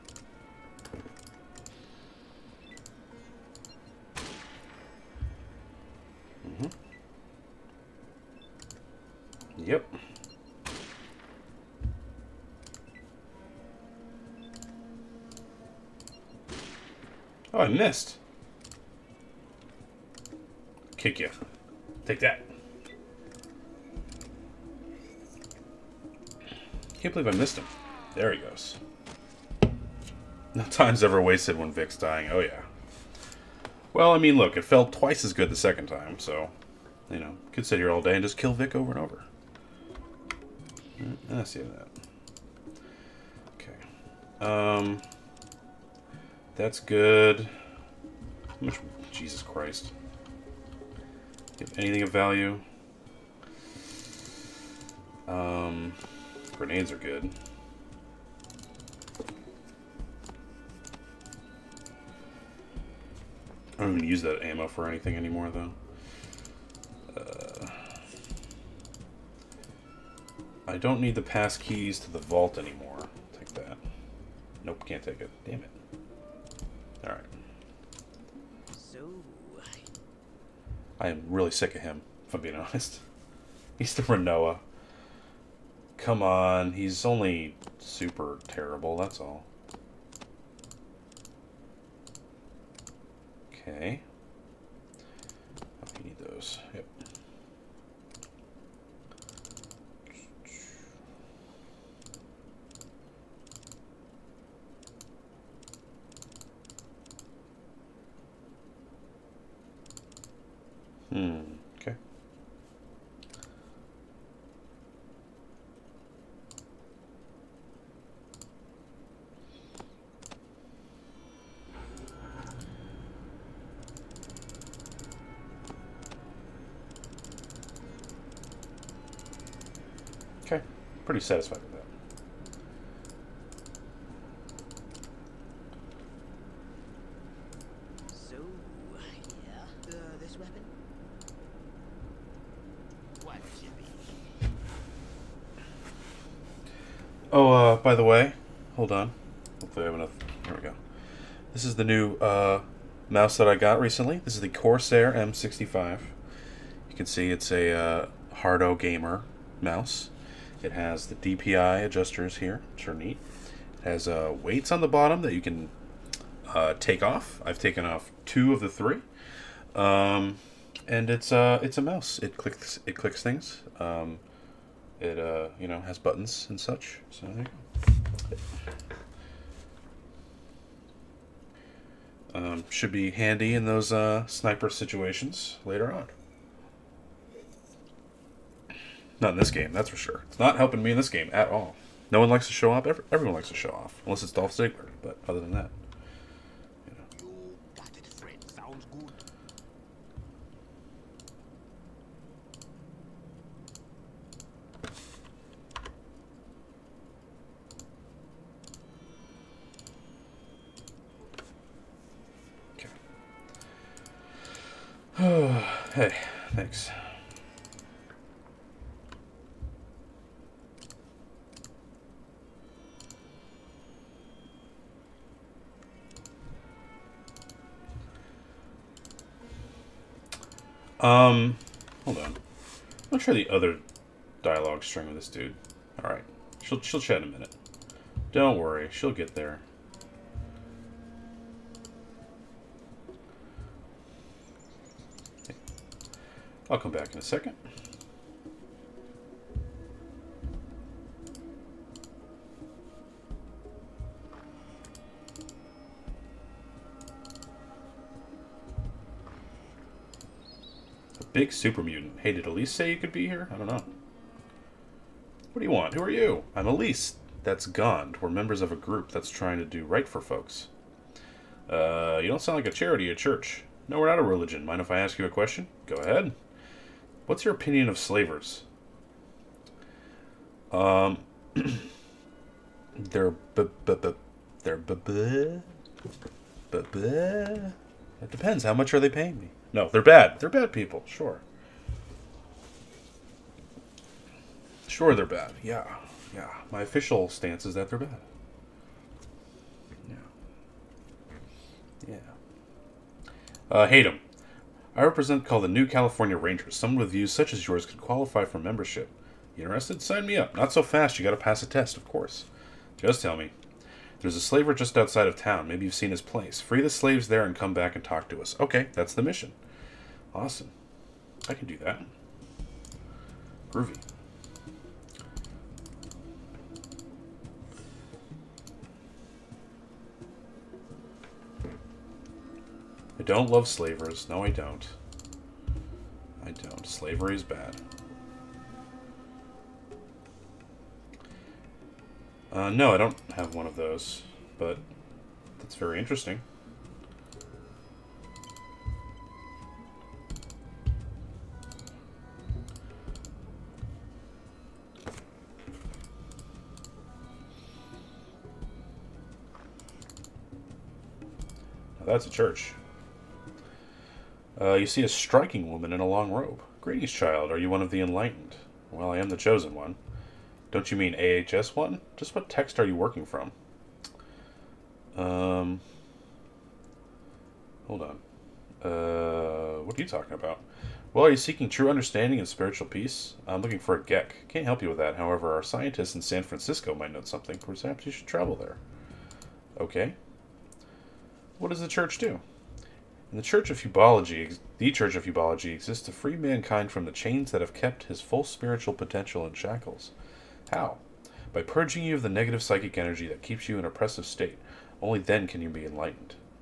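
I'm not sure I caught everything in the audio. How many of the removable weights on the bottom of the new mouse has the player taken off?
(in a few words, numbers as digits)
2.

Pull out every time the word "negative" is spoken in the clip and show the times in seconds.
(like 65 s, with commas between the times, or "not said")
402 s.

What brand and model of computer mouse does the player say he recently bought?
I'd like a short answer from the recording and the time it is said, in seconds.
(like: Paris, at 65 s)
Corsair M65, at 154 s.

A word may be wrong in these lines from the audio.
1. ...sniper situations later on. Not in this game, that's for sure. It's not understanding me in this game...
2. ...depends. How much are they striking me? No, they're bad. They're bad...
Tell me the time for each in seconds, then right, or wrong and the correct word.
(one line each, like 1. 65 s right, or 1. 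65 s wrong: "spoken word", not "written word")
1. 184 s wrong: "helping", not "understanding"
2. 288 s wrong: "paying", not "striking".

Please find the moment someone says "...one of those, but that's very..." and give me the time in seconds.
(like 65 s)
343 s.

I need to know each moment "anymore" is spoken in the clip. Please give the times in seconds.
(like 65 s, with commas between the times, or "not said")
65 s, 72 s.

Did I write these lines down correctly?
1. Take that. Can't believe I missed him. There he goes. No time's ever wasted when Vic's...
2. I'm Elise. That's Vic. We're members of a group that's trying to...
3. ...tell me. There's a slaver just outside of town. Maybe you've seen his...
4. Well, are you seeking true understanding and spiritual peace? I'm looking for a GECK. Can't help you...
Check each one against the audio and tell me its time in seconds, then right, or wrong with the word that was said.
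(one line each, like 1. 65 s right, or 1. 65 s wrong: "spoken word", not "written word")
1. 22 s right
2. 266 s wrong: "Gond", not "Vic"
3. 313 s right
4. 381 s right.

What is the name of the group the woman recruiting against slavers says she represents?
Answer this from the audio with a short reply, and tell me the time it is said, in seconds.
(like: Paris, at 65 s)
New California Rangers, at 305 s.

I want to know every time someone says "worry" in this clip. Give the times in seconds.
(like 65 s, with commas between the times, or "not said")
238 s.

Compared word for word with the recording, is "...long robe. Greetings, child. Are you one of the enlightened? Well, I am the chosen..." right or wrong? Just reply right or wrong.
right.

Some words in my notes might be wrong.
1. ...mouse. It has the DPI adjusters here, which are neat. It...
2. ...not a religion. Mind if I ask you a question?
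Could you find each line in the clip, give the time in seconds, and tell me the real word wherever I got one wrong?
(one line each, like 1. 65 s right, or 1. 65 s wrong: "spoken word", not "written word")
1. 159 s right
2. 274 s right.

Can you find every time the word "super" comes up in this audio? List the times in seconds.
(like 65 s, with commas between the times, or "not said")
87 s, 261 s.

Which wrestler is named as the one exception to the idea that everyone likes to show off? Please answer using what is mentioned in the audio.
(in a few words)
Dolph Ziggler.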